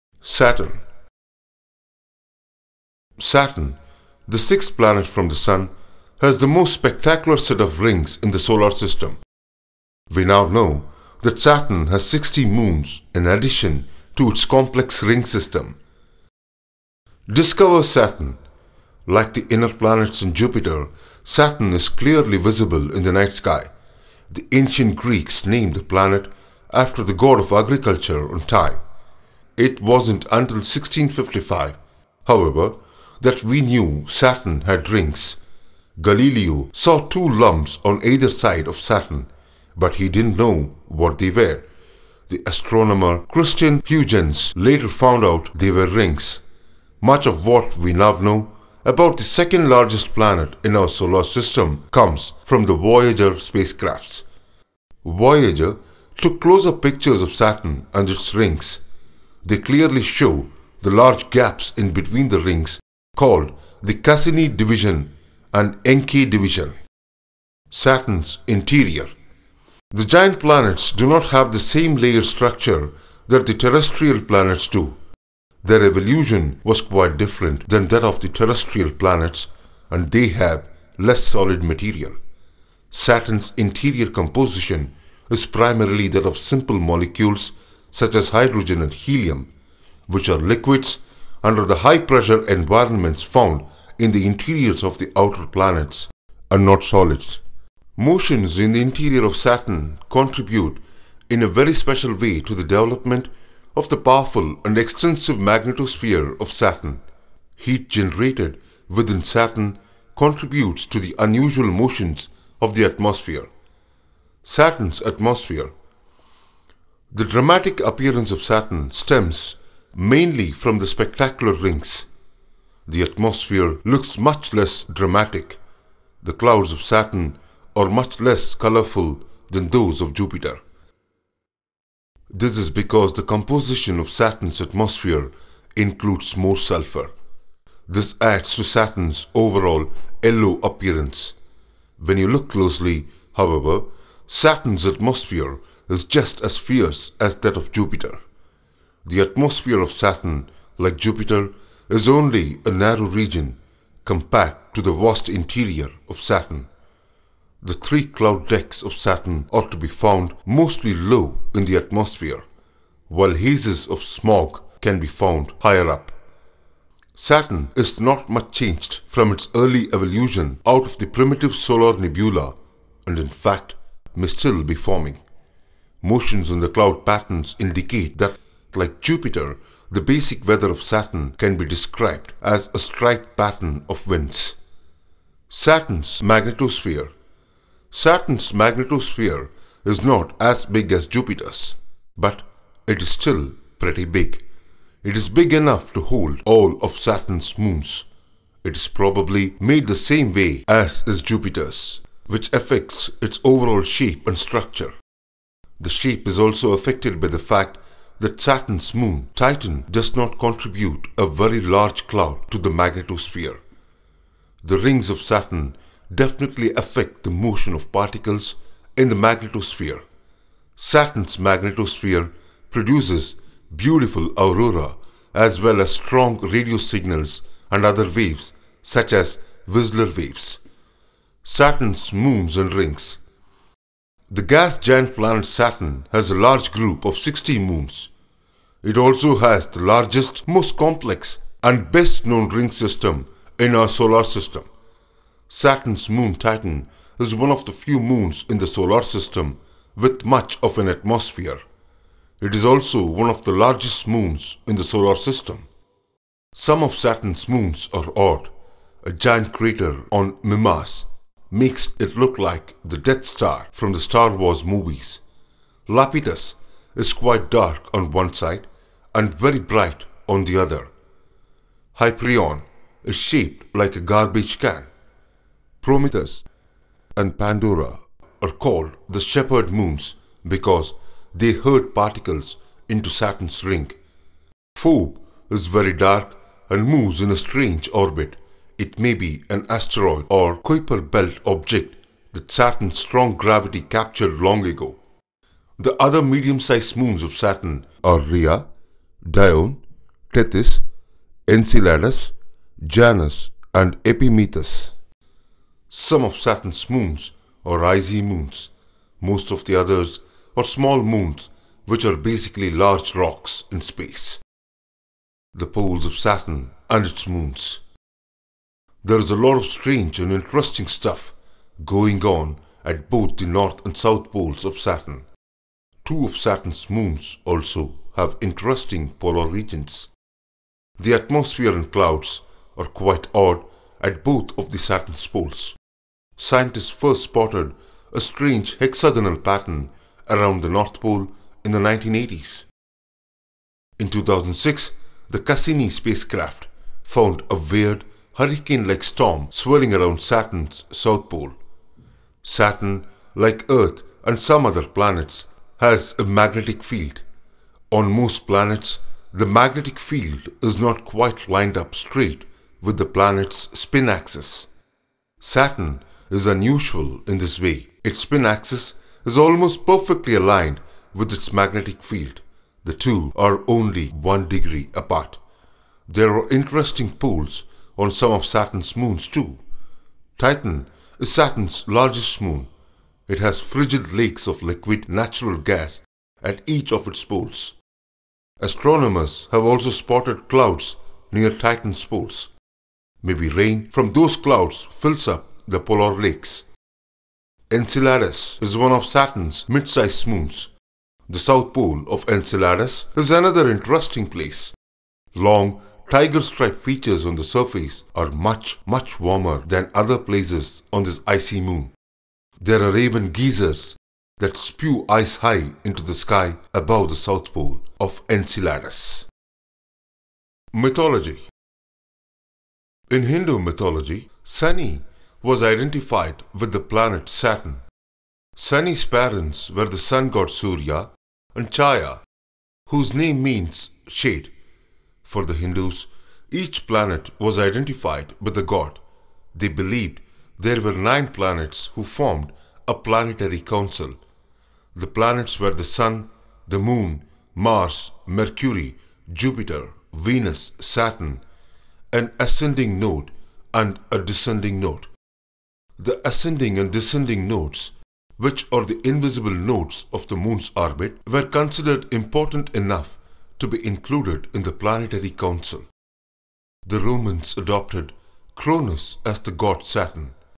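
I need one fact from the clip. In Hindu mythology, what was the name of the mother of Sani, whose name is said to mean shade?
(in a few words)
Chaya.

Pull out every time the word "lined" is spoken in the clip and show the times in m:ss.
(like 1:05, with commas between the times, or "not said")
6:01.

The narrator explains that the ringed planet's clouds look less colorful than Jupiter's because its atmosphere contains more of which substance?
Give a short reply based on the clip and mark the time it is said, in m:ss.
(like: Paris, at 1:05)
Sulfur, at 2:16.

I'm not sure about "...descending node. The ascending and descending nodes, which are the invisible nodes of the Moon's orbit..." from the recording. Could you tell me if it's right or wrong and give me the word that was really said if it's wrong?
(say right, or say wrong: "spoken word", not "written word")
right.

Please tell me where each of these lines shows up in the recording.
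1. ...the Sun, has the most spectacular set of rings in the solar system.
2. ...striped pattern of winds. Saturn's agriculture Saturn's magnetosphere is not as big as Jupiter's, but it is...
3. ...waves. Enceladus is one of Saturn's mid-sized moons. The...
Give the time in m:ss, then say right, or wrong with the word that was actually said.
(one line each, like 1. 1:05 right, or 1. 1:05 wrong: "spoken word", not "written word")
1. 0:05 right
2. 3:02 wrong: "magnetosphere", not "agriculture"
3. 6:36 wrong: "lakes", not "waves".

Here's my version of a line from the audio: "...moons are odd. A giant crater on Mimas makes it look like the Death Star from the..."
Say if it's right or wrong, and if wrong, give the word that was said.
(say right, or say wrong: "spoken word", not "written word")
right.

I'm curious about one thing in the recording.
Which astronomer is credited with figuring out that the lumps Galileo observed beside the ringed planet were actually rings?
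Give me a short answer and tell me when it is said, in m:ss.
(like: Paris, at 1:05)
Christian Huygens, at 0:43.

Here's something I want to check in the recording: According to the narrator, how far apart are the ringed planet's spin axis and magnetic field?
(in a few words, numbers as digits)
1 degree.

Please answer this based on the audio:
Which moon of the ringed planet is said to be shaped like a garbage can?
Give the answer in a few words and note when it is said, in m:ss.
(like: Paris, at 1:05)
Hyperion, at 4:31.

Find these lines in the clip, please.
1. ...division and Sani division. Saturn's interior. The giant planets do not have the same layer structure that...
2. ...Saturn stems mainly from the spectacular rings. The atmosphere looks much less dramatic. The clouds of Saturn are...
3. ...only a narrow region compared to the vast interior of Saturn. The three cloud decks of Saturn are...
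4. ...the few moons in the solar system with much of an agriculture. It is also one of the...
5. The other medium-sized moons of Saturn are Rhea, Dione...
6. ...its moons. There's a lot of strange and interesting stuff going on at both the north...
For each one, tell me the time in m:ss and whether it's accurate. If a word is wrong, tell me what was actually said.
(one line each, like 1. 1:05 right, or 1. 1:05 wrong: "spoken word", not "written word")
1. 1:04 wrong: "Encke", not "Sani"
2. 1:58 right
3. 2:32 right
4. 4:07 wrong: "atmosphere", not "agriculture"
5. 4:55 right
6. 5:17 right.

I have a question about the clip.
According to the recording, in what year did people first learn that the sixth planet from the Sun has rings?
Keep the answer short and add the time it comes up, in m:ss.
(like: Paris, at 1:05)
1655, at 0:30.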